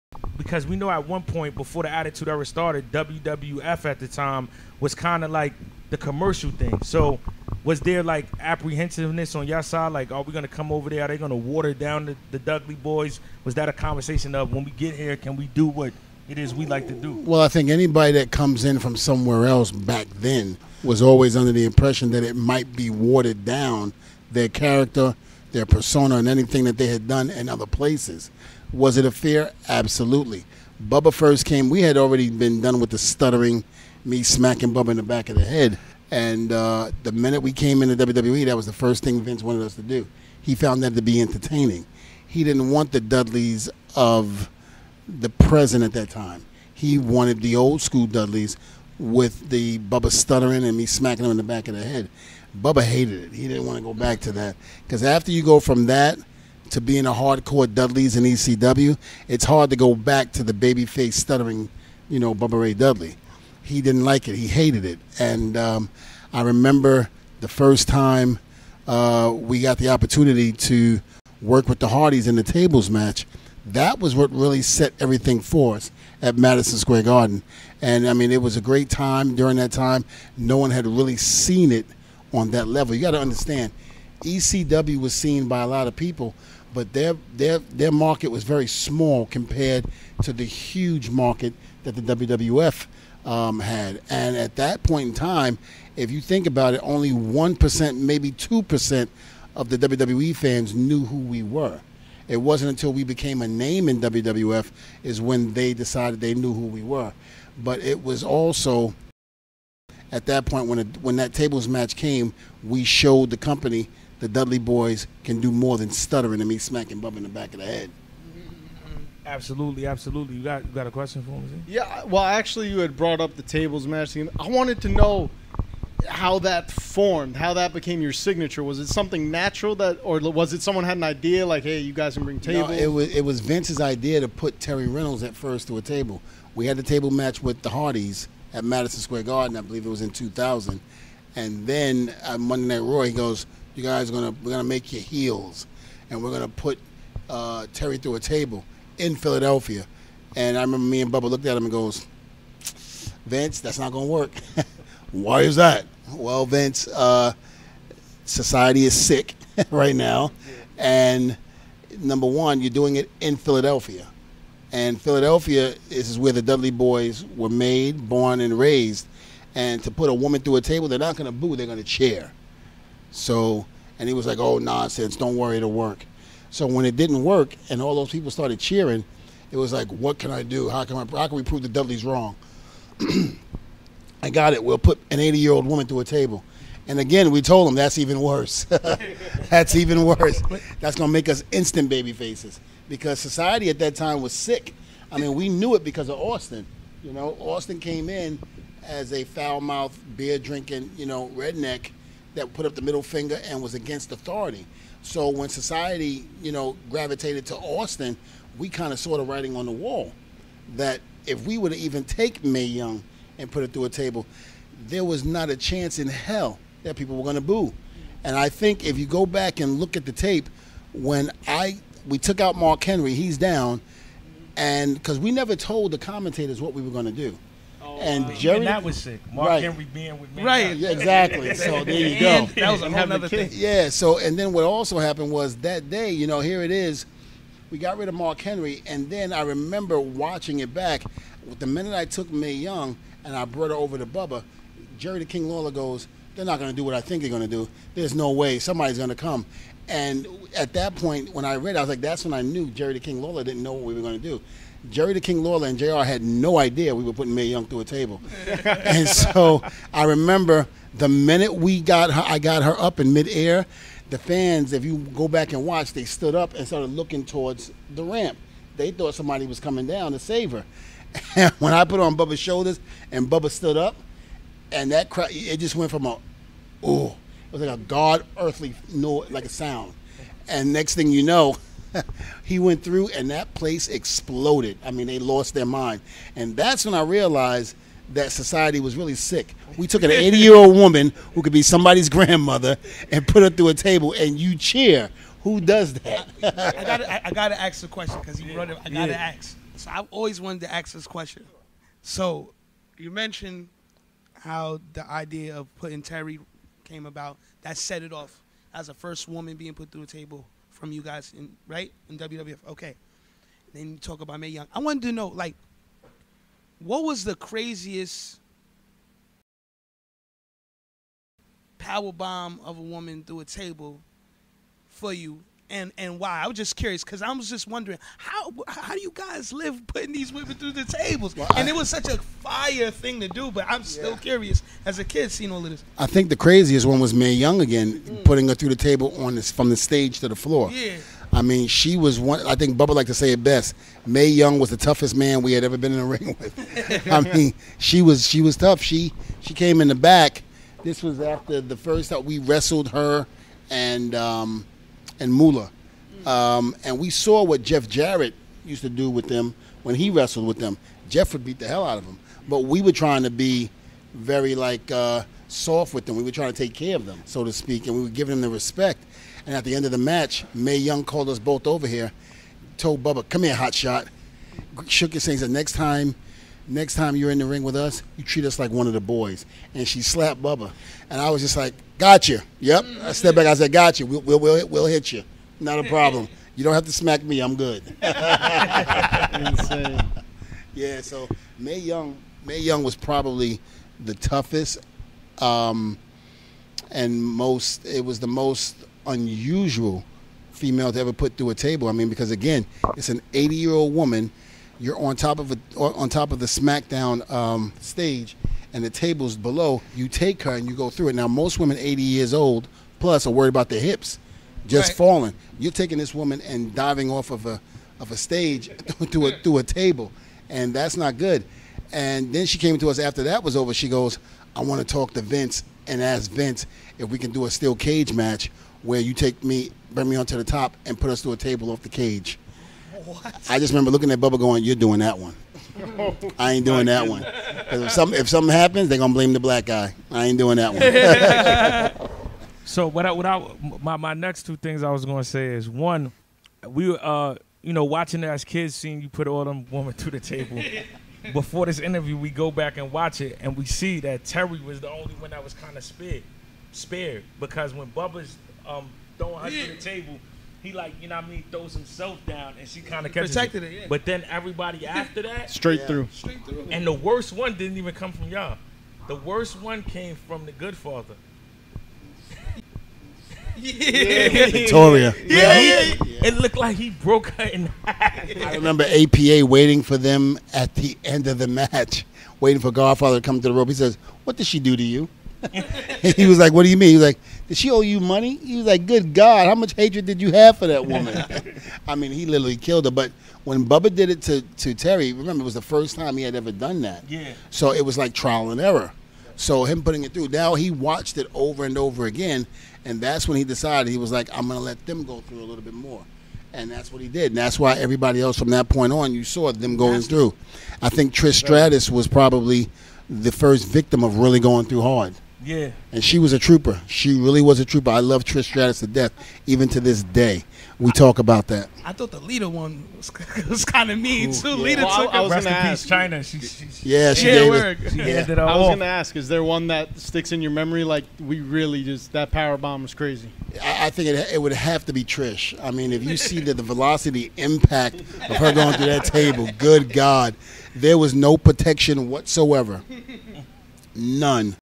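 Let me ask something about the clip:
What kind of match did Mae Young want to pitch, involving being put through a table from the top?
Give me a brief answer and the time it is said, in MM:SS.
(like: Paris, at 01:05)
Steel cage match, at 07:07.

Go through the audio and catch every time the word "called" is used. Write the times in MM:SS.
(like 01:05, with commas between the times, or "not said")
06:11.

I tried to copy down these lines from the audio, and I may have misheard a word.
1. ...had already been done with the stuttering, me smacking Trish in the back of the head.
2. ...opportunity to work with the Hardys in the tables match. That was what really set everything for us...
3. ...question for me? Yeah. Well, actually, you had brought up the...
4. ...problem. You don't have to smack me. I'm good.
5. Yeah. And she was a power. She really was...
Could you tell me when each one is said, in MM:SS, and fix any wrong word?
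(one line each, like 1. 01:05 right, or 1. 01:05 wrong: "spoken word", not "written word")
1. 00:31 wrong: "Bubba", not "Trish"
2. 01:09 right
3. 02:00 right
4. 06:25 right
5. 08:35 wrong: "trooper", not "power".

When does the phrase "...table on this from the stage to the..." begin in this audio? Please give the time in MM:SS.
05:38.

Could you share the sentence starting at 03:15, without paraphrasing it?
I mean, we knew it because of Austin.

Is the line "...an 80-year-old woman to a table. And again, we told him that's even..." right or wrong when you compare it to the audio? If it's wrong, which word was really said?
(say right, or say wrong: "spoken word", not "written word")
right.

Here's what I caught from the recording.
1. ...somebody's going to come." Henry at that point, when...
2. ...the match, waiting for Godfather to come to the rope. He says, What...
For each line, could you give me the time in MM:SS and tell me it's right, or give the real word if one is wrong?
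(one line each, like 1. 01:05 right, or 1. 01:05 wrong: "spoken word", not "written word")
1. 04:08 wrong: "And", not "Henry"
2. 08:01 right.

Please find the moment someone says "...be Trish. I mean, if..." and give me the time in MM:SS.
08:54.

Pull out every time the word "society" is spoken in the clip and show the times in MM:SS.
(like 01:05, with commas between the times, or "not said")
02:38, 03:13, 03:25, 04:48.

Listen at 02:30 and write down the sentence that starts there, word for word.
And I remember me and Bubba looked at him and goes, Vince, that's not gonna work.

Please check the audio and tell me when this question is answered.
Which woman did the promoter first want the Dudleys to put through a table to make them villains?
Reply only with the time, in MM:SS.
02:14.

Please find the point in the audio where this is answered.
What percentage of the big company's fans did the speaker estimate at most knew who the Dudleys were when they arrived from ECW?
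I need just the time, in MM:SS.
01:38.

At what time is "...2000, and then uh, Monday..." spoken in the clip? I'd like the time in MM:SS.
02:20.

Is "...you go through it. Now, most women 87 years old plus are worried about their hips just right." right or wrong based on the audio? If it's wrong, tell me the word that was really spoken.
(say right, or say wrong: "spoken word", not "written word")
wrong: "80", not "87".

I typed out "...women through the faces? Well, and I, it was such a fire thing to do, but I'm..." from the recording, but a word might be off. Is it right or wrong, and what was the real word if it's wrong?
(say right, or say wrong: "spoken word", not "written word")
wrong: "tables", not "faces".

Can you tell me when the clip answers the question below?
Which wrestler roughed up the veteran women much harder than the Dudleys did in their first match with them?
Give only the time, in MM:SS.
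05:57.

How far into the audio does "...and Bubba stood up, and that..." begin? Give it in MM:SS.
04:33.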